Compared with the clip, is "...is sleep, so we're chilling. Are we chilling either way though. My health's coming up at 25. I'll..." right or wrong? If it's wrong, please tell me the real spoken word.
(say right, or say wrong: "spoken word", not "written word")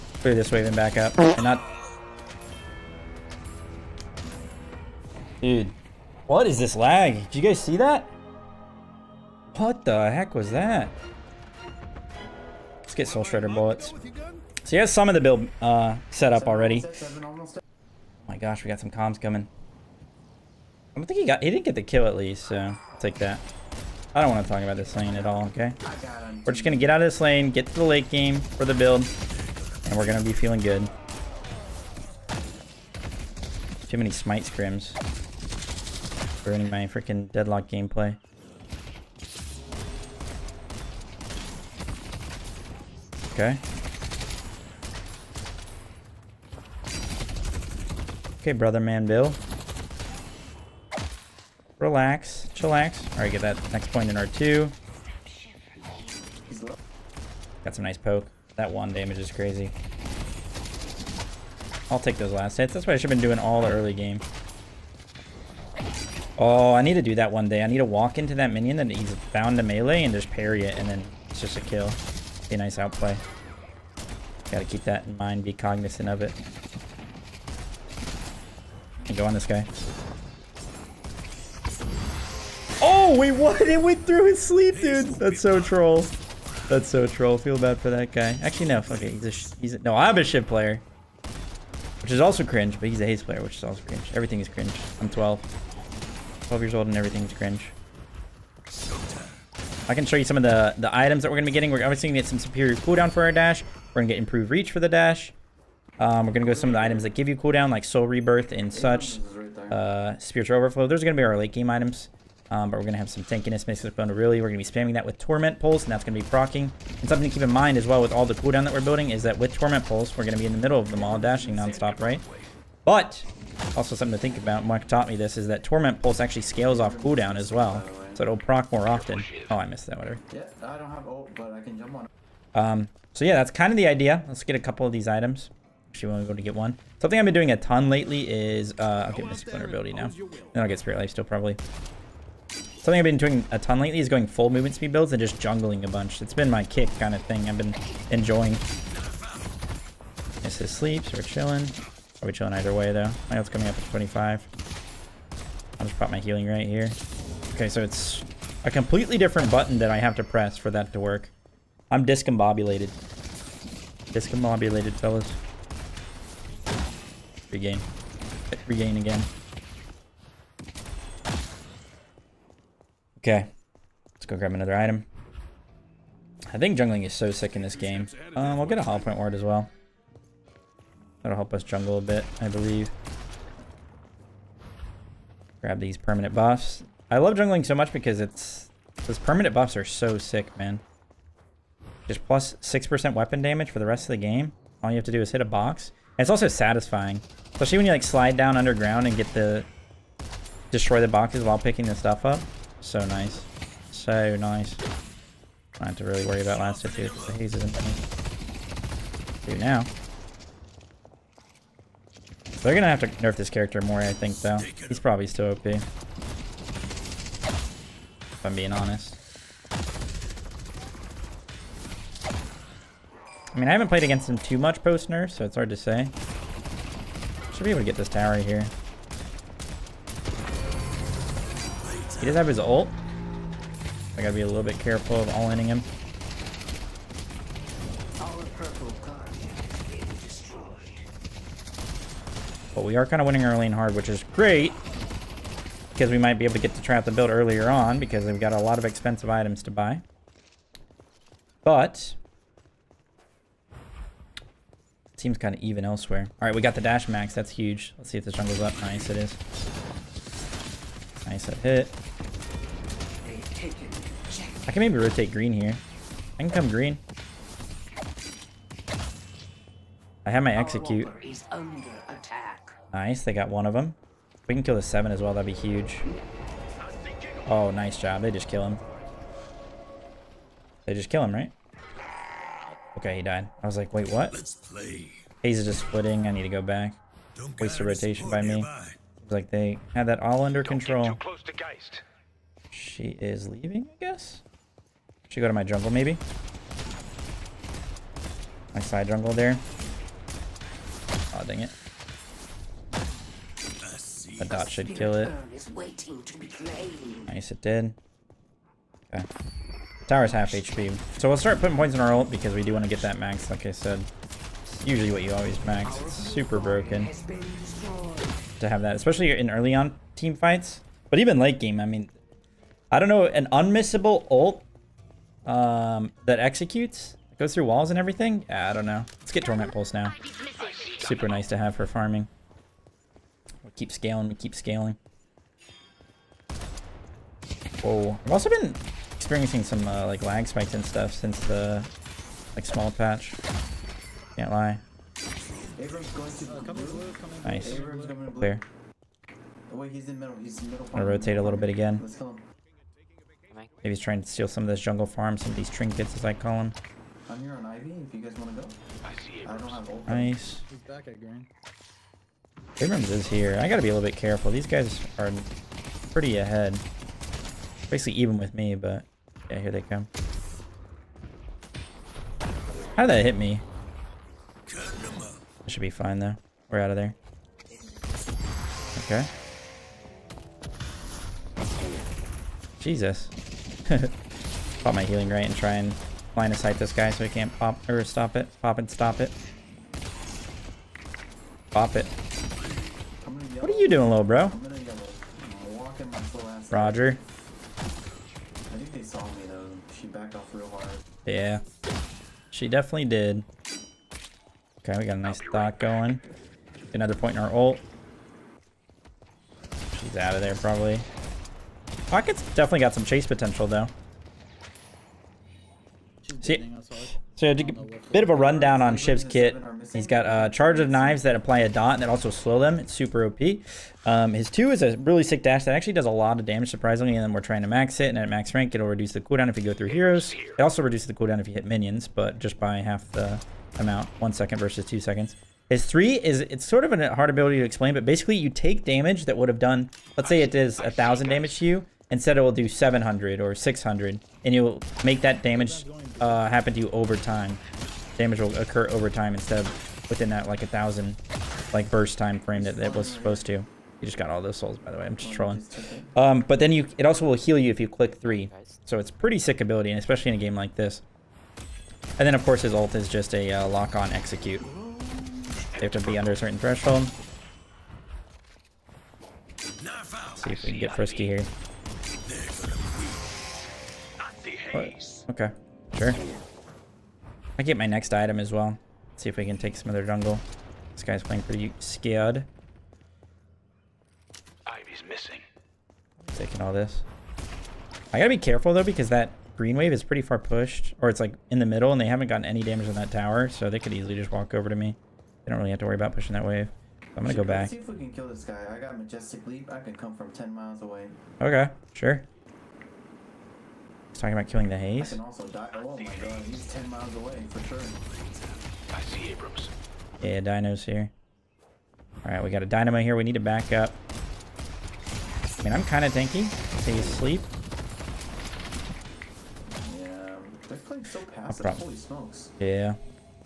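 right.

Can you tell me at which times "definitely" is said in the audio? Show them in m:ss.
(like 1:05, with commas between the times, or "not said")
6:42, 6:52.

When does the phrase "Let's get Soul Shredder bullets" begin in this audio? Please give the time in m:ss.
0:12.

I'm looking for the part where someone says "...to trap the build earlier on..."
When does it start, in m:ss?
4:06.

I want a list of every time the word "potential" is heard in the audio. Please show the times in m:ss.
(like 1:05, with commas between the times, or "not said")
6:53.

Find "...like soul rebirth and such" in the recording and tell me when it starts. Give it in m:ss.
1:47.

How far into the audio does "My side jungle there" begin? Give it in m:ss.
4:58.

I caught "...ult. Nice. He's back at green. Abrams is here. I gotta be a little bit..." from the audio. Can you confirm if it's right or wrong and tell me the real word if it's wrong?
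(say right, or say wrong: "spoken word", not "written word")
right.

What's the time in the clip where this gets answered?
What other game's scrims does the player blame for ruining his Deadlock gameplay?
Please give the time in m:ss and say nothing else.
0:34.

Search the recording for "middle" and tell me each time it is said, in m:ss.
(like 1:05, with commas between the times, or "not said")
2:00, 8:11.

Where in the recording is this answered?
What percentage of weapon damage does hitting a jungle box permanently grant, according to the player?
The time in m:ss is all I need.
3:12.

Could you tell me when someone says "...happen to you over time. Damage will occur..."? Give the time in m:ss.
7:26.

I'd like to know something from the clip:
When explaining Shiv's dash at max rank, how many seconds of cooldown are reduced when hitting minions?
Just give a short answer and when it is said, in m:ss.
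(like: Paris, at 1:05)
1 second, at 7:14.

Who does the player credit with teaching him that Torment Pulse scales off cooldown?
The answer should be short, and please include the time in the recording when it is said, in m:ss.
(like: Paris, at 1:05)
Mark, at 2:04.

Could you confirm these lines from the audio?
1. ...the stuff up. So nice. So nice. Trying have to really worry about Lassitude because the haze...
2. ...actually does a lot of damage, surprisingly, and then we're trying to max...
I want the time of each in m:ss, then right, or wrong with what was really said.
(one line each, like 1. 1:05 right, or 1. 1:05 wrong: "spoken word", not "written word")
1. 3:21 right
2. 7:05 right.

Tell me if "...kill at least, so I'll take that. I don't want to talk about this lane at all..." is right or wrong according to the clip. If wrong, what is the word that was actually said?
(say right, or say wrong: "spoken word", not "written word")
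right.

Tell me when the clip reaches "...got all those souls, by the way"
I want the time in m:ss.
7:34.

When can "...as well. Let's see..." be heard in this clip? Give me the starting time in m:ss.
7:58.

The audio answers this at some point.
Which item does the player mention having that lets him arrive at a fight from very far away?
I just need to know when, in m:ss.
8:18.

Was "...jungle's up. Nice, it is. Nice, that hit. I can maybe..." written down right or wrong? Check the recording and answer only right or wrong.
right.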